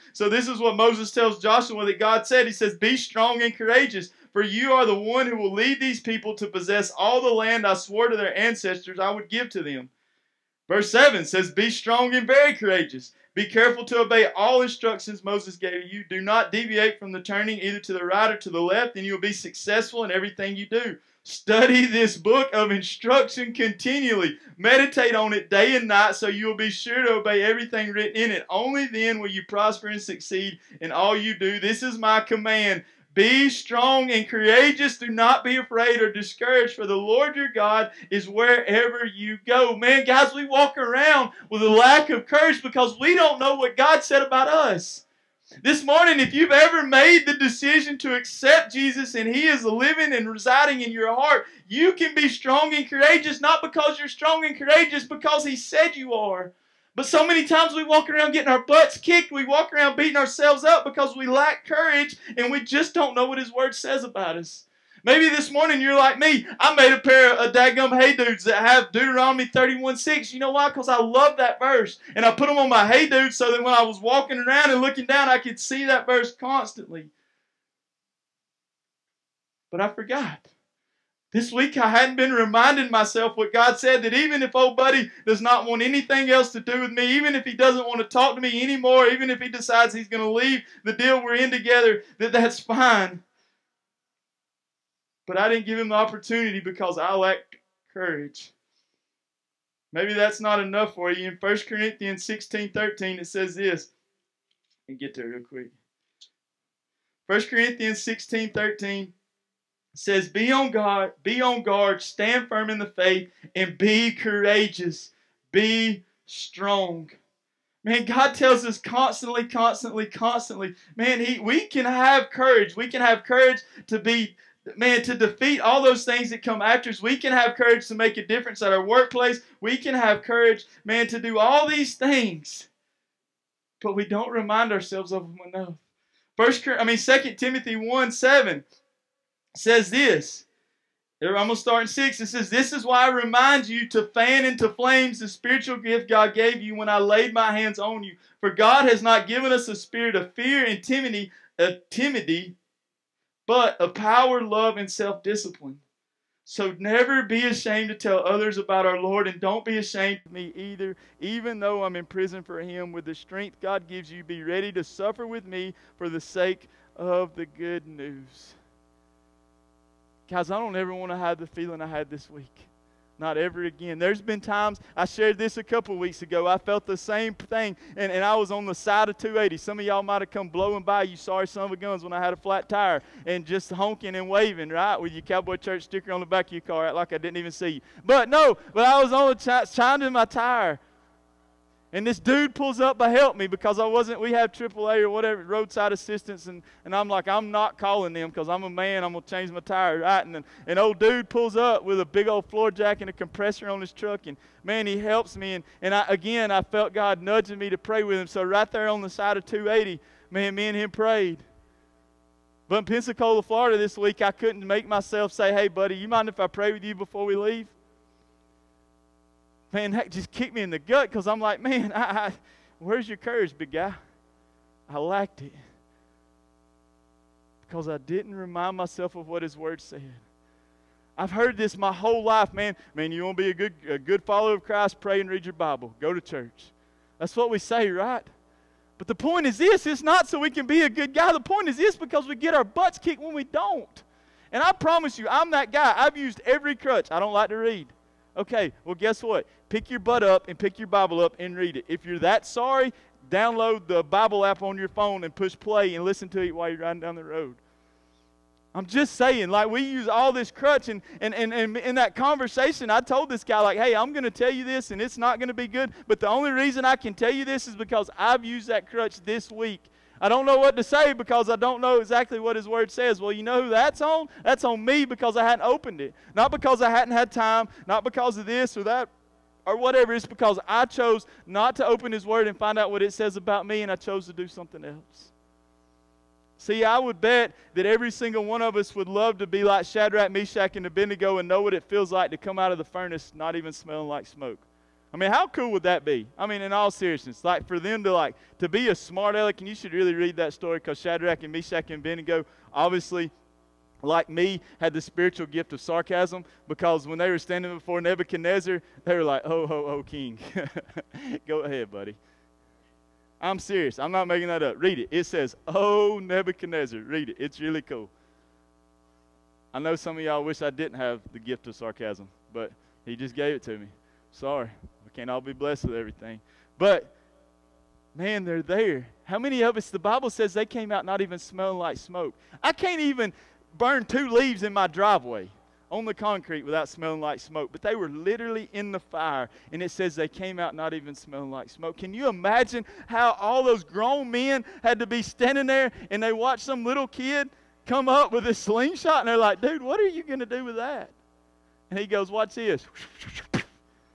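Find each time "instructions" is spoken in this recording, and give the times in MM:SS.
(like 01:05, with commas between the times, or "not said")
00:14, 00:22.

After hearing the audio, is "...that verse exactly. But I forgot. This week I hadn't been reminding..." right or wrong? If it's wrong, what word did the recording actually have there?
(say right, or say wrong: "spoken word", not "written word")
wrong: "constantly", not "exactly".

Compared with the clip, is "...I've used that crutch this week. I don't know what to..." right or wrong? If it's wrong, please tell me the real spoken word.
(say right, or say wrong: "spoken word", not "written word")
right.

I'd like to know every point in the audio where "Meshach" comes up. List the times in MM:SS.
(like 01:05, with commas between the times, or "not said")
04:50, 05:01.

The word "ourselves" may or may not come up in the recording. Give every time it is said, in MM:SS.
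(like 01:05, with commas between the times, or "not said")
01:00, 02:14.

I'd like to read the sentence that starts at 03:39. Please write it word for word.
man, that just kicked me in the gut because I'm like, man, I, I, where's your courage, big guy?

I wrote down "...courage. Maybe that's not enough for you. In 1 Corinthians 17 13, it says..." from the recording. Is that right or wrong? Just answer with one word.
wrong.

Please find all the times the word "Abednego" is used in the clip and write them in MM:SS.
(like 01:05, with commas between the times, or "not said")
04:50, 05:02.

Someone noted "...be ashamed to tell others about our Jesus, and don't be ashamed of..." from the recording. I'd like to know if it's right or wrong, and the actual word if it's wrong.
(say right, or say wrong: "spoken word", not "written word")
wrong: "Lord", not "Jesus".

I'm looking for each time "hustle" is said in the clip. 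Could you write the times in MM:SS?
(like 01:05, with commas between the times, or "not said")
not said.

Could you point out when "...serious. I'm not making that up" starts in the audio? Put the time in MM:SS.
05:13.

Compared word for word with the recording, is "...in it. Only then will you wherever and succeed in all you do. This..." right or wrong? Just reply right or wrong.
wrong.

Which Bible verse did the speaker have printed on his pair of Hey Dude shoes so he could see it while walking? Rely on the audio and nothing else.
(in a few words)
Deuteronomy 31:6.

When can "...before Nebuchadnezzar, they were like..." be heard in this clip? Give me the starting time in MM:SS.
05:07.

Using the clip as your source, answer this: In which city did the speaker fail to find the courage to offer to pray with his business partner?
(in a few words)
Pensacola, Florida.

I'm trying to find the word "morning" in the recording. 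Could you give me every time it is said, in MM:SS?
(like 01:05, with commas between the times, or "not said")
00:45, 01:05.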